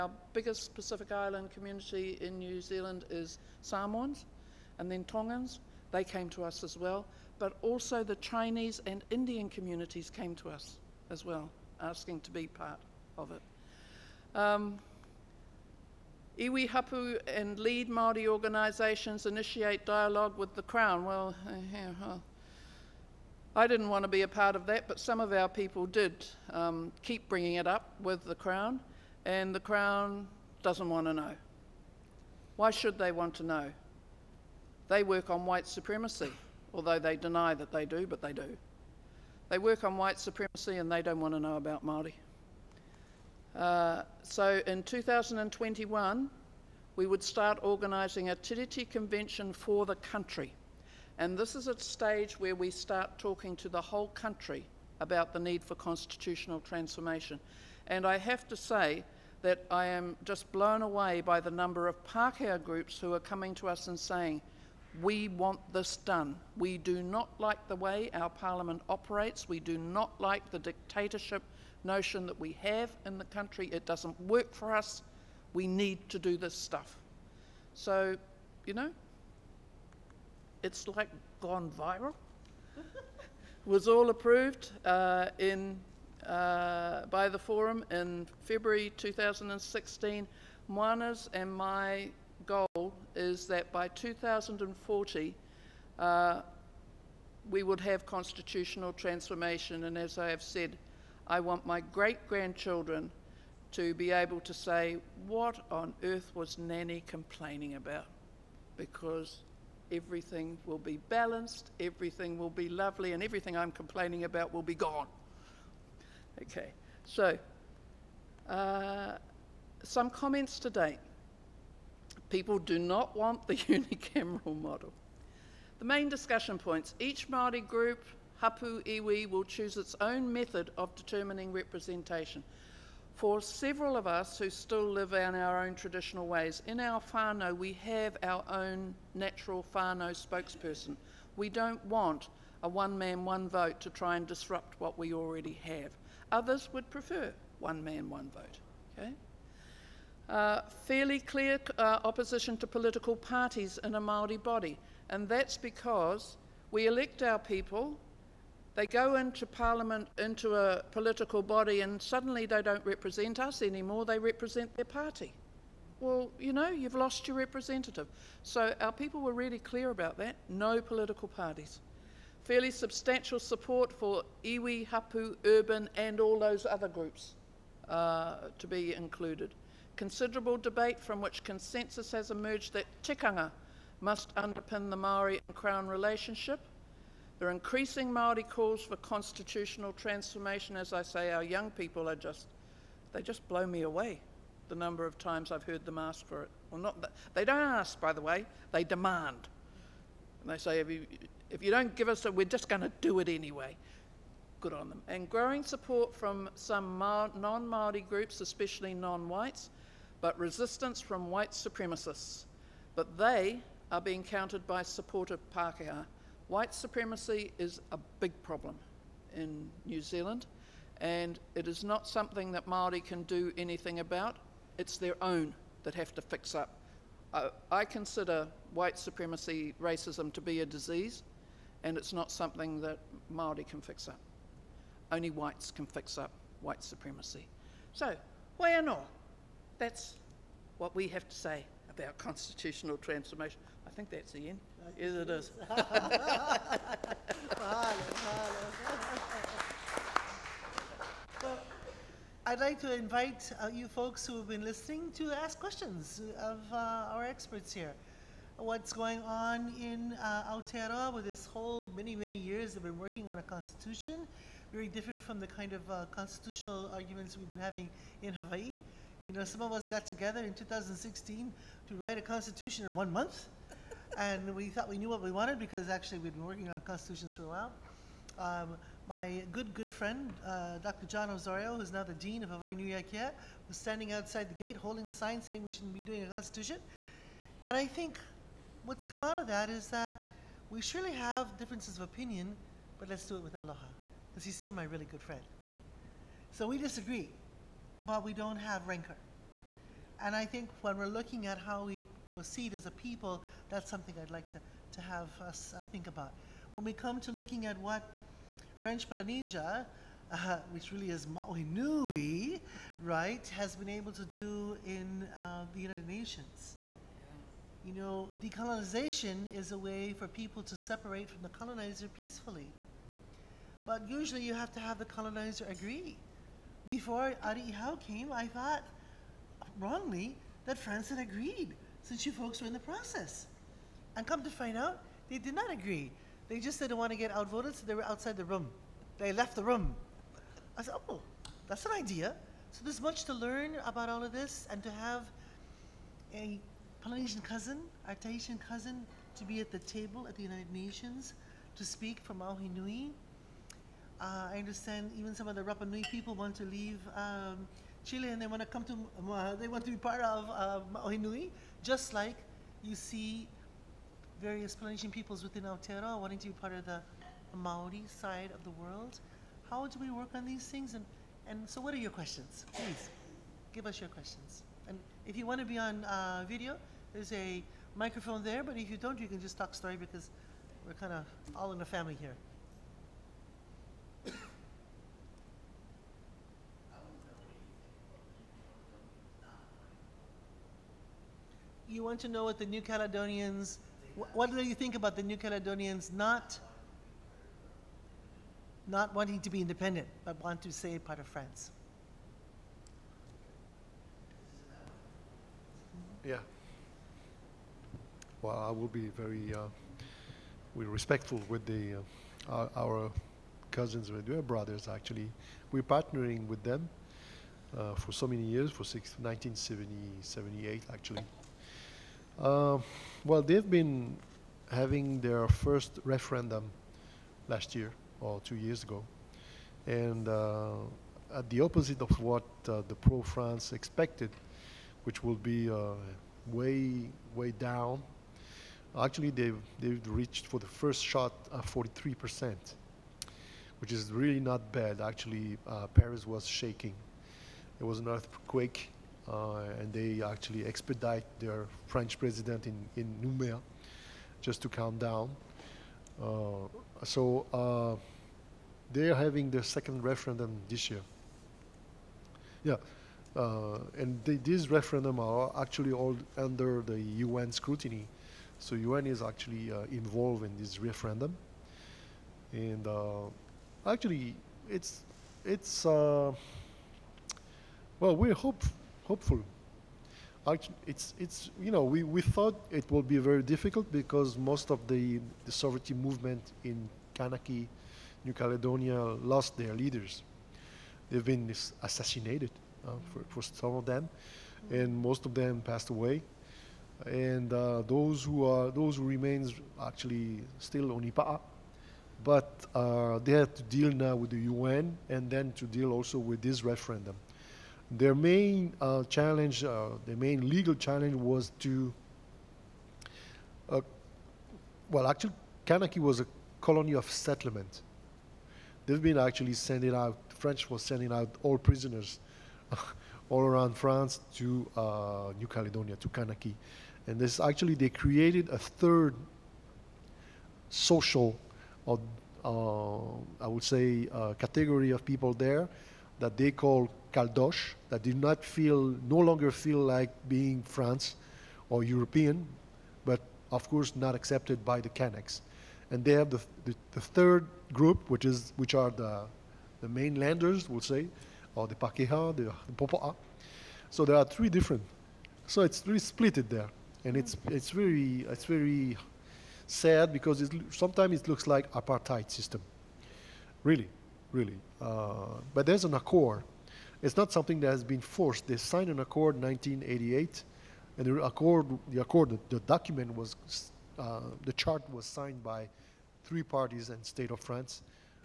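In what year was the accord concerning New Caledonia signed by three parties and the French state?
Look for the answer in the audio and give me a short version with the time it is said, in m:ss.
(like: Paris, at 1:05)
1988, at 9:29.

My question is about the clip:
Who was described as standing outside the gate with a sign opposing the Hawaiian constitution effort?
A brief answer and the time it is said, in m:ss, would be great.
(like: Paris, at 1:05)
Dr. Jon Osorio, at 4:40.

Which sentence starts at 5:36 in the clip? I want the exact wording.
They just didn't want to get outvoted, so they were outside the room.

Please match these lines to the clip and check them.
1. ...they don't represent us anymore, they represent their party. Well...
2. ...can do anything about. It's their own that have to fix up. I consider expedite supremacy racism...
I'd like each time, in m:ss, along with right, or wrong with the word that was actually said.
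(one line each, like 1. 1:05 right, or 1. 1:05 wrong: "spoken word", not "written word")
1. 2:42 right
2. 3:43 wrong: "white", not "expedite".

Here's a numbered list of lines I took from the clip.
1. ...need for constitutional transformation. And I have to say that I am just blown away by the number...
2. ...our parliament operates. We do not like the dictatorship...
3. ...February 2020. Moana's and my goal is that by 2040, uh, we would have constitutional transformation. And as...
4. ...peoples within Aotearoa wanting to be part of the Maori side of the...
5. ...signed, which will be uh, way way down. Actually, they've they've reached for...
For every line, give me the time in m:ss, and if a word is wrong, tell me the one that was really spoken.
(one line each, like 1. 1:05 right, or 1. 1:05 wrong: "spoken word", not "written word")
1. 0:55 right
2. 1:08 right
3. 1:28 wrong: "2016", not "2020"
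4. 6:05 right
5. 7:13 wrong: "expected", not "signed".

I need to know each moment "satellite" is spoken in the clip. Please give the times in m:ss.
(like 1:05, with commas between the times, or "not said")
not said.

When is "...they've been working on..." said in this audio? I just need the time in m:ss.
4:22.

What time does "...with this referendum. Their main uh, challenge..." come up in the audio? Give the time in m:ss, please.
8:26.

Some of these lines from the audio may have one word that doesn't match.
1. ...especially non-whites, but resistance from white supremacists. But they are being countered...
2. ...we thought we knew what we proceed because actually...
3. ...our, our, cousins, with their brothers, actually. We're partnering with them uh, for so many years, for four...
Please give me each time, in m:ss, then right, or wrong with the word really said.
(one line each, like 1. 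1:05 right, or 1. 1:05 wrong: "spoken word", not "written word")
1. 3:28 right
2. 4:34 wrong: "wanted", not "proceed"
3. 6:52 wrong: "six", not "four".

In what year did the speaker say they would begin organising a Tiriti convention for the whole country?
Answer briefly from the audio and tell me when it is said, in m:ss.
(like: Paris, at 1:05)
2021, at 0:44.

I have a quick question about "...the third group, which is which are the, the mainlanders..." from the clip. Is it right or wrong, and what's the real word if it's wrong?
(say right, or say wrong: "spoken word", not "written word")
right.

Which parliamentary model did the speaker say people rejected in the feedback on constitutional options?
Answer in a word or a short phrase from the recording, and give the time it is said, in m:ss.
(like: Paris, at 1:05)
unicameral model, at 2:03.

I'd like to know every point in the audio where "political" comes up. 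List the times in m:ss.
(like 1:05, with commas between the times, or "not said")
2:32, 2:40, 2:50.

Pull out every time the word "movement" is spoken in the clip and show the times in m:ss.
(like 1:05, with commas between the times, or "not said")
8:05.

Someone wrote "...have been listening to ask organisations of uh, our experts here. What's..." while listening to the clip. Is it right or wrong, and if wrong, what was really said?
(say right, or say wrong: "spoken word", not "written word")
wrong: "questions", not "organisations".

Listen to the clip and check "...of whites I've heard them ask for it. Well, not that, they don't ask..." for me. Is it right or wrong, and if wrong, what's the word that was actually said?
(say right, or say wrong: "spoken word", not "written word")
wrong: "times", not "whites".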